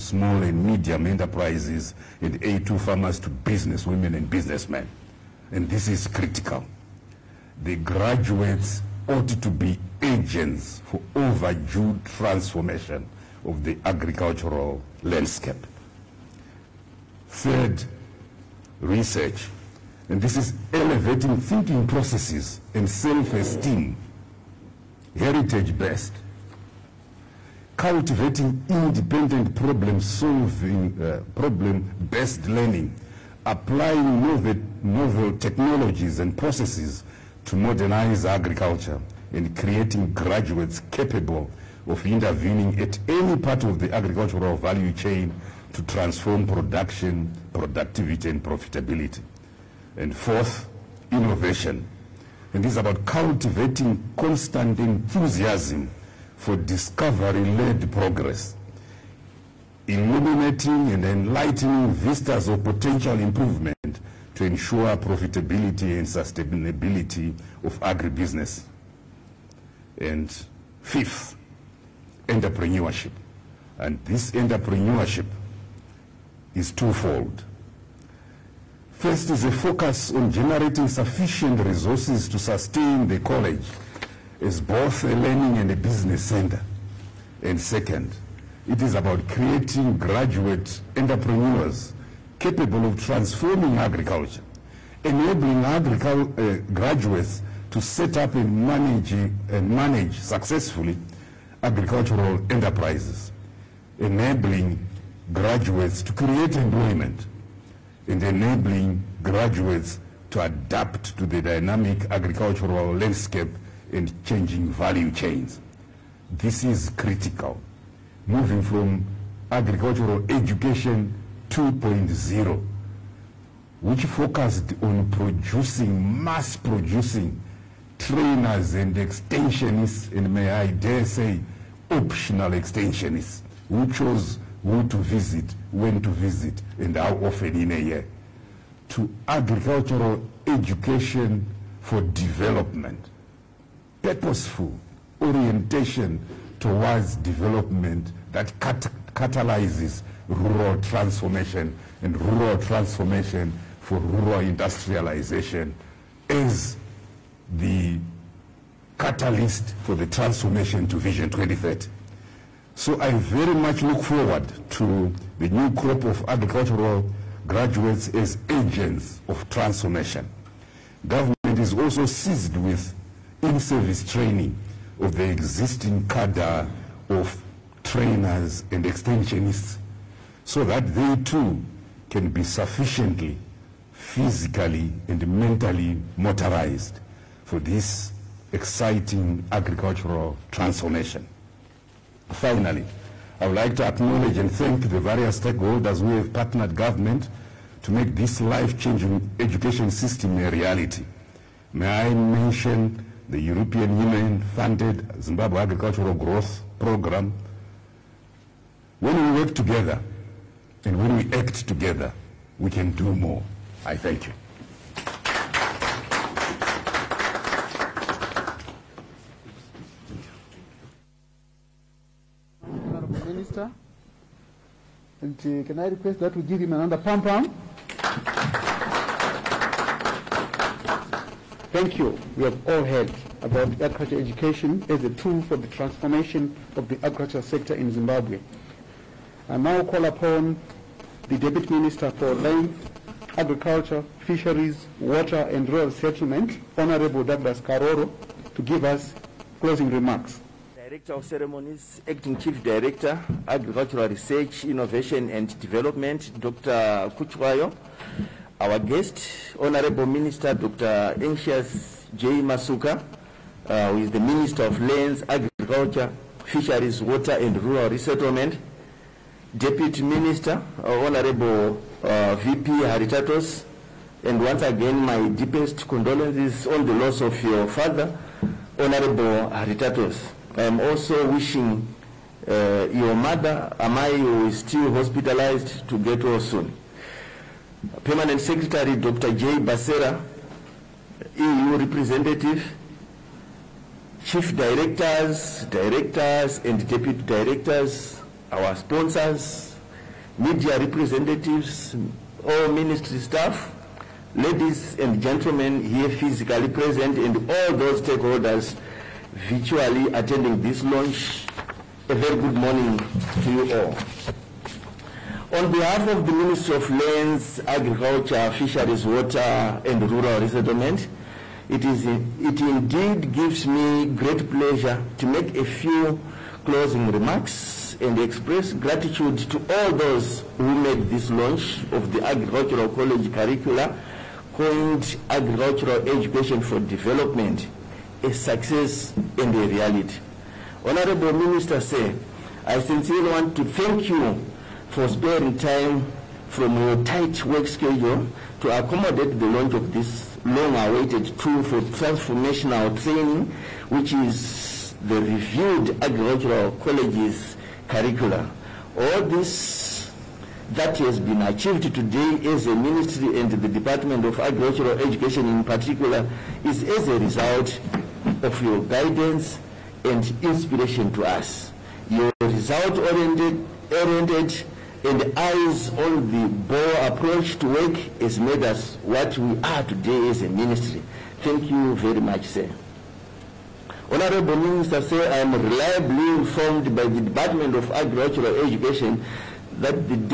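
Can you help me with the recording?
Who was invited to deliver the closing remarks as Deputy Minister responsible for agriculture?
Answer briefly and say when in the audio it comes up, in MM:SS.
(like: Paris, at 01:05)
Douglas Karoro, at 04:07.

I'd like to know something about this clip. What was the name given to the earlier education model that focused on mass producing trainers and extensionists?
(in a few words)
Agricultural education 2.0.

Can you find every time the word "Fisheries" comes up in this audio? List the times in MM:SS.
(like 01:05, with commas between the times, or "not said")
04:04, 04:26, 05:18.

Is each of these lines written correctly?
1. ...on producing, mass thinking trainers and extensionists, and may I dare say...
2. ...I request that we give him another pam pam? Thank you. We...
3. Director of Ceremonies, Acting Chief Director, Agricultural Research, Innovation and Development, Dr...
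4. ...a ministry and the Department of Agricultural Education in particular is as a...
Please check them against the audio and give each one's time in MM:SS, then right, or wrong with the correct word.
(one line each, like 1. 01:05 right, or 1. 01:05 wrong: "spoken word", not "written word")
1. 02:04 wrong: "producing", not "thinking"
2. 03:45 right
3. 04:10 right
4. 06:02 right.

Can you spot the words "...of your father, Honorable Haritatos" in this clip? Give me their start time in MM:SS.
04:37.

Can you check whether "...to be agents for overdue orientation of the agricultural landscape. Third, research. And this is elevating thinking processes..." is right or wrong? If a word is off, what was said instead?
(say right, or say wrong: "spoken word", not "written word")
wrong: "transformation", not "orientation".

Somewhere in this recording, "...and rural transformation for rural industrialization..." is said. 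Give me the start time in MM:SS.
02:32.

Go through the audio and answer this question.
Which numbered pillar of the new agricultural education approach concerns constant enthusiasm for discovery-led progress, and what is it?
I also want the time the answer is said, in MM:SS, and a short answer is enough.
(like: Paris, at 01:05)
Fourth, innovation, at 00:50.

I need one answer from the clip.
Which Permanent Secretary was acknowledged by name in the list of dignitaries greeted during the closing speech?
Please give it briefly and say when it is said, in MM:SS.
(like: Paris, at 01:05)
Dr. J. Basera, at 04:48.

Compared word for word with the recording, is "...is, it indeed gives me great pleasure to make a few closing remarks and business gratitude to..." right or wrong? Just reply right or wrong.
wrong.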